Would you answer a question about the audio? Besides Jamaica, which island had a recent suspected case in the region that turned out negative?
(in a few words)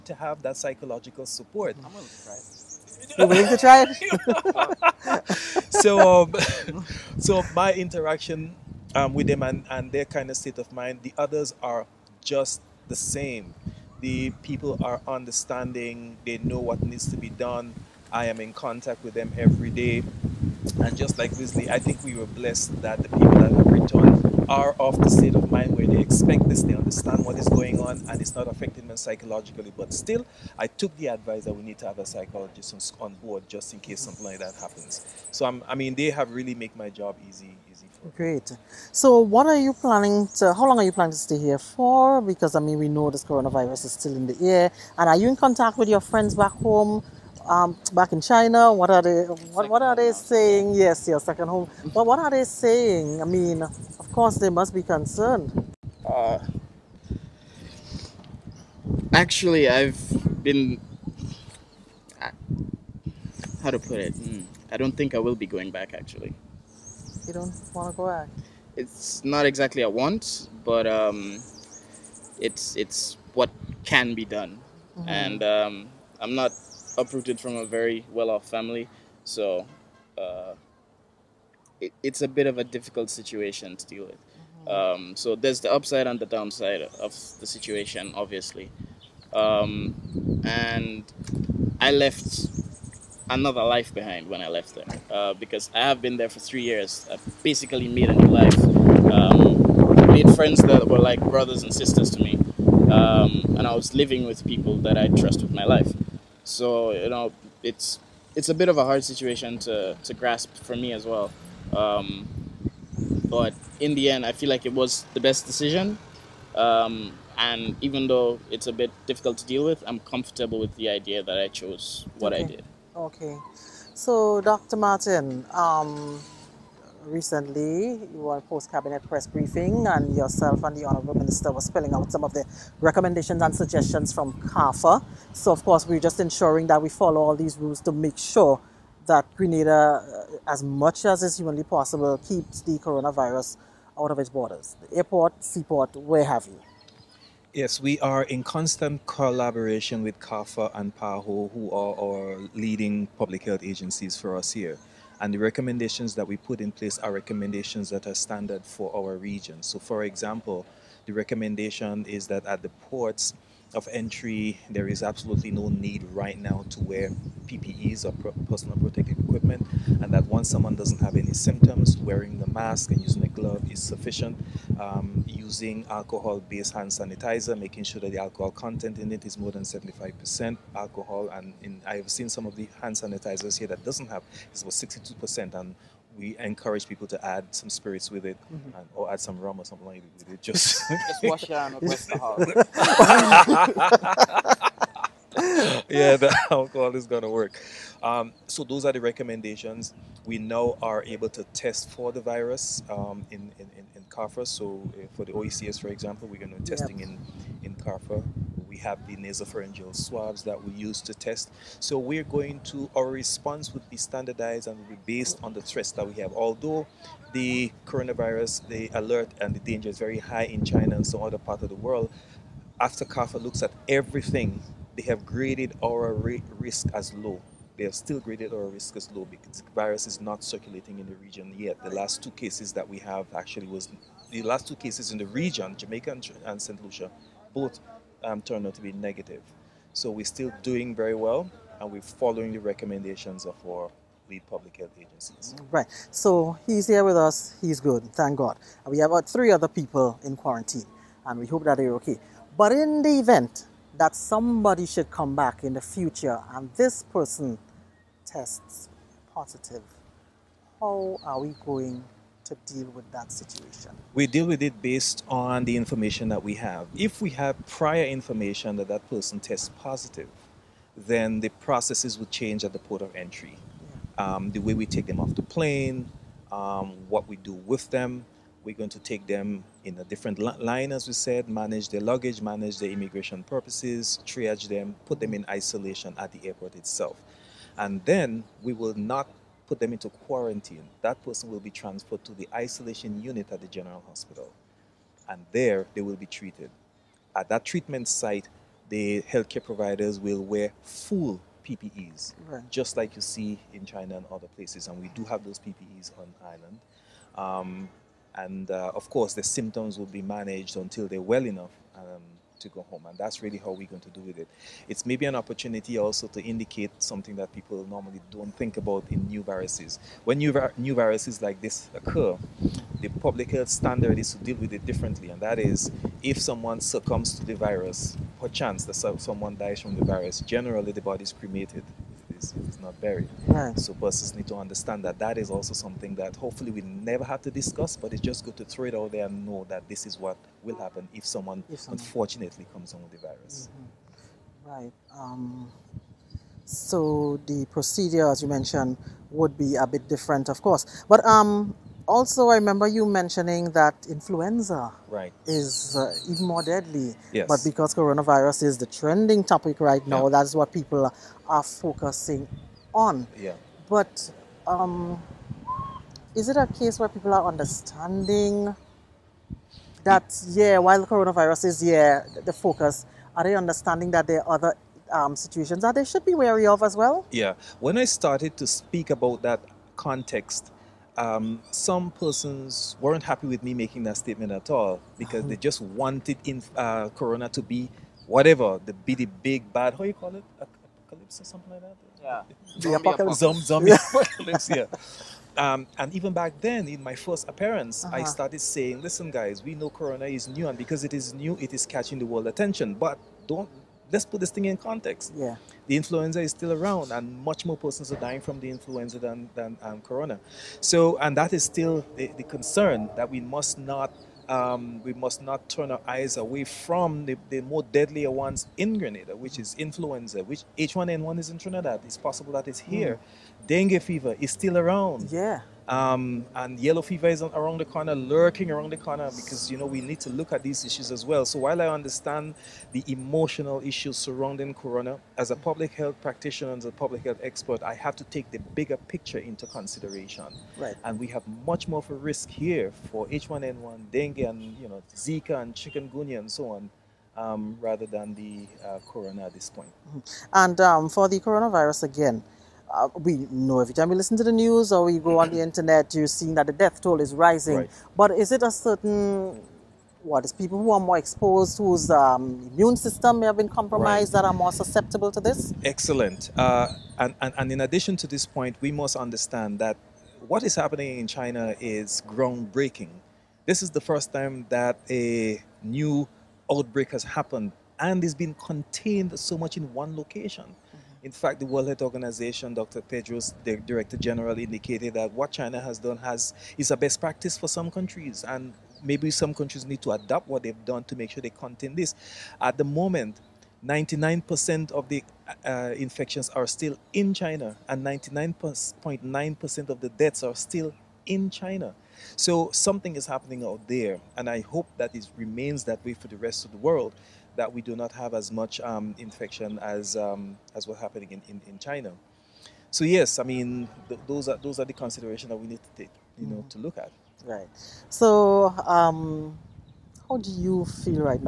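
St. Lucia.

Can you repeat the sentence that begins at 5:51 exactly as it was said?
But um, also, I remember you mentioning that influenza right.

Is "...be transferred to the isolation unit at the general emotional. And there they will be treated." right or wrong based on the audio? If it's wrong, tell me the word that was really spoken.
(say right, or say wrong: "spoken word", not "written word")
wrong: "hospital", not "emotional".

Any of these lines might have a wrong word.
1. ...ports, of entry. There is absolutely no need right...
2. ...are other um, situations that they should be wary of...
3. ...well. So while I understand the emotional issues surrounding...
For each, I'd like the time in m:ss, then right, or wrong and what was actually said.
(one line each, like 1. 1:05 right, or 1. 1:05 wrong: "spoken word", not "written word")
1. 2:42 right
2. 6:14 right
3. 7:11 right.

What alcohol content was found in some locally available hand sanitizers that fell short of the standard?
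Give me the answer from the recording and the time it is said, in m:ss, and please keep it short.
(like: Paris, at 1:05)
62%, at 3:04.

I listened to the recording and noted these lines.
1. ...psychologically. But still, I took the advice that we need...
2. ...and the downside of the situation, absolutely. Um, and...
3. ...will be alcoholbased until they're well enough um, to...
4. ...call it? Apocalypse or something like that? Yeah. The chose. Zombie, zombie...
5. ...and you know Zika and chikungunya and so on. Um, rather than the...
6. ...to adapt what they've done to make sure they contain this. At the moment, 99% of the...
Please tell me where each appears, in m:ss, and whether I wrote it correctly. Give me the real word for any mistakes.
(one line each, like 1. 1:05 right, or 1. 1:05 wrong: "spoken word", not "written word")
1. 0:28 right
2. 1:26 wrong: "obviously", not "absolutely"
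3. 5:09 wrong: "managed", not "alcoholbased"
4. 6:30 wrong: "apocalypse", not "chose"
5. 7:24 right
6. 8:10 right.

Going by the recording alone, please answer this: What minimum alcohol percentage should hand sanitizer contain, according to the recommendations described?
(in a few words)
More than 75%.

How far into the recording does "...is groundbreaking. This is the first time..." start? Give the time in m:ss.
7:51.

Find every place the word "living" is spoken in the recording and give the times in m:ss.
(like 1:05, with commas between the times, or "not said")
1:43.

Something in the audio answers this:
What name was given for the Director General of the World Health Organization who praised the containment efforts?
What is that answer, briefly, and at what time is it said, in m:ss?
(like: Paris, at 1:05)
Dr. Tedros, at 8:02.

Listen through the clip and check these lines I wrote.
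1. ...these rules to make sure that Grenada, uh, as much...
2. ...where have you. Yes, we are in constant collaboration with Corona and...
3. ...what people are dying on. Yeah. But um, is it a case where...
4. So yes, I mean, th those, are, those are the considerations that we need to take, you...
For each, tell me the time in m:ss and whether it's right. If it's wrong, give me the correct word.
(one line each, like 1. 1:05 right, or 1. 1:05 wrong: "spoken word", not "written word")
1. 2:17 right
2. 2:25 wrong: "CARPHA", not "Corona"
3. 6:00 wrong: "focusing", not "dying"
4. 8:32 right.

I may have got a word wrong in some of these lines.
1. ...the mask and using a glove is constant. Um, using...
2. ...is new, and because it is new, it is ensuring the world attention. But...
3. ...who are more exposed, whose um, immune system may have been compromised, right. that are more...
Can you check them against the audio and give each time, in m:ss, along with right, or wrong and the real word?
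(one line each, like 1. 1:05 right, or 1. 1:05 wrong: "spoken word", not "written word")
1. 2:52 wrong: "sufficient", not "constant"
2. 6:40 wrong: "catching", not "ensuring"
3. 7:40 right.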